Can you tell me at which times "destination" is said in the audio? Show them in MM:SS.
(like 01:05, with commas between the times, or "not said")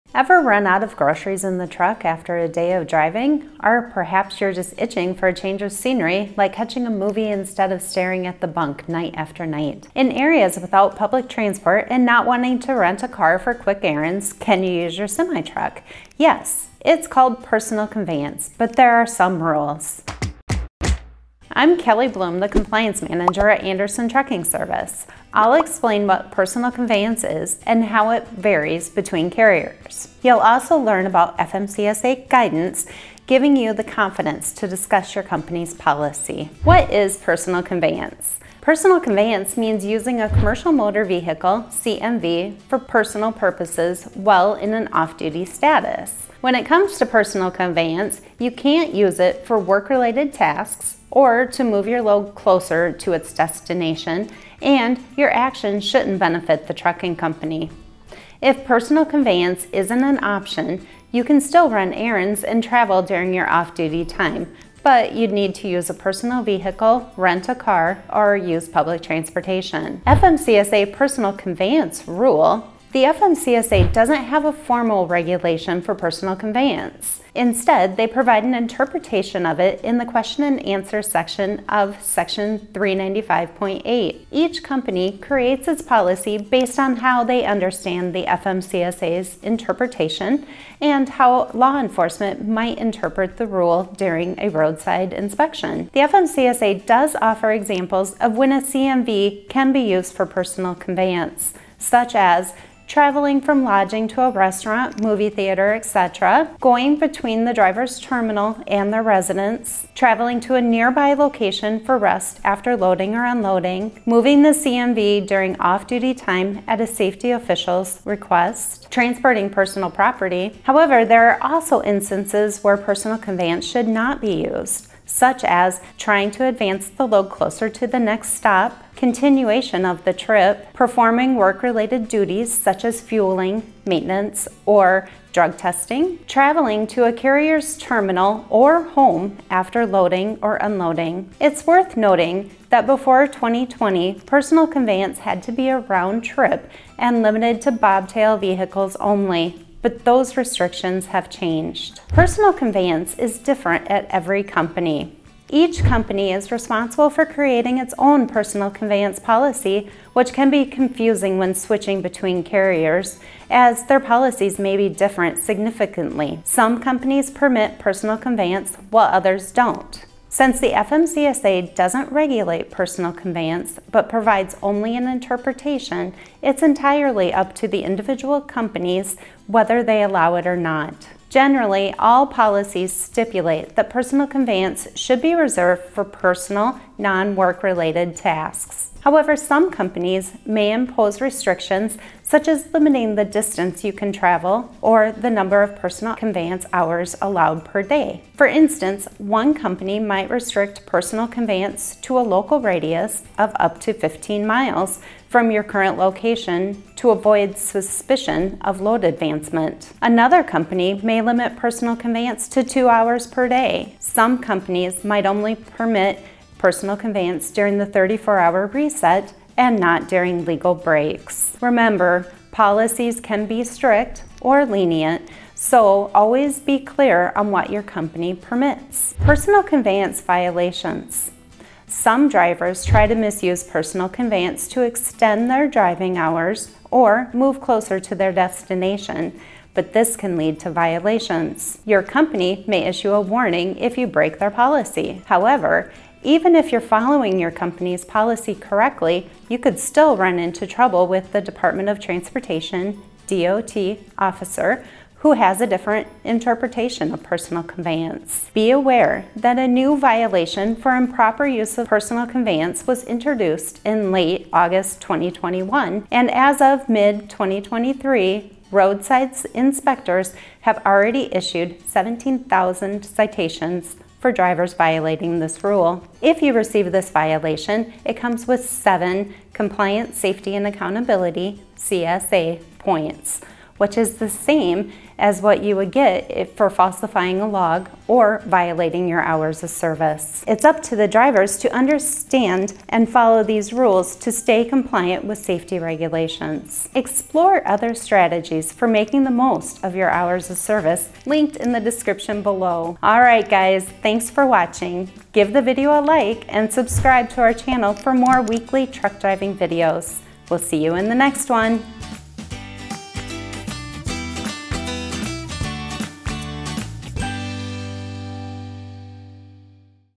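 00:53, 03:58.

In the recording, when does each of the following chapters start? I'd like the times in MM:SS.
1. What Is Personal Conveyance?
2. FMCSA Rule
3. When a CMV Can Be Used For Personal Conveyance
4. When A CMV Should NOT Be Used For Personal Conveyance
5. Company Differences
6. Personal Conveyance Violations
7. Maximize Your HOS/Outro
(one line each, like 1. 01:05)
1. 00:37
2. 01:10
3. 01:41
4. 02:04
5. 02:33
6. 03:49
7. 04:56.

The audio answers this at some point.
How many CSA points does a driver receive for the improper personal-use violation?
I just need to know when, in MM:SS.
04:38.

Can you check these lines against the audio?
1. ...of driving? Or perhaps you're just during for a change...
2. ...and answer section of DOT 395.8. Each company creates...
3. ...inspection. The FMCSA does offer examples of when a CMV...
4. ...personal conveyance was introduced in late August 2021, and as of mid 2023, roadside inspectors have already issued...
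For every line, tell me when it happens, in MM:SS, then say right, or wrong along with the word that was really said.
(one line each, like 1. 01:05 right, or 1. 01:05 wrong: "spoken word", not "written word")
1. 00:02 wrong: "itching", not "during"
2. 01:20 wrong: "Section", not "DOT"
3. 01:35 right
4. 04:21 right.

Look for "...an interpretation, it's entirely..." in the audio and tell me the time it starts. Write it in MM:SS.
02:54.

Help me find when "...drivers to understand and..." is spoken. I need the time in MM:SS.
04:51.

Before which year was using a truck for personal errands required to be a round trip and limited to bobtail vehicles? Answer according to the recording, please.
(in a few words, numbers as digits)
2020.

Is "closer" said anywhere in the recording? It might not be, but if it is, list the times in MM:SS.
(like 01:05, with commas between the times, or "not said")
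00:52, 02:07, 03:57.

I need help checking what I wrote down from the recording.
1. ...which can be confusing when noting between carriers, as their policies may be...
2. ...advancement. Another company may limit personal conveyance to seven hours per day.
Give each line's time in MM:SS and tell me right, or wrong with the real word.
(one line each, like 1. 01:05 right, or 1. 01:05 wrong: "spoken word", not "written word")
1. 02:40 wrong: "switching", not "noting"
2. 03:29 wrong: "two", not "seven".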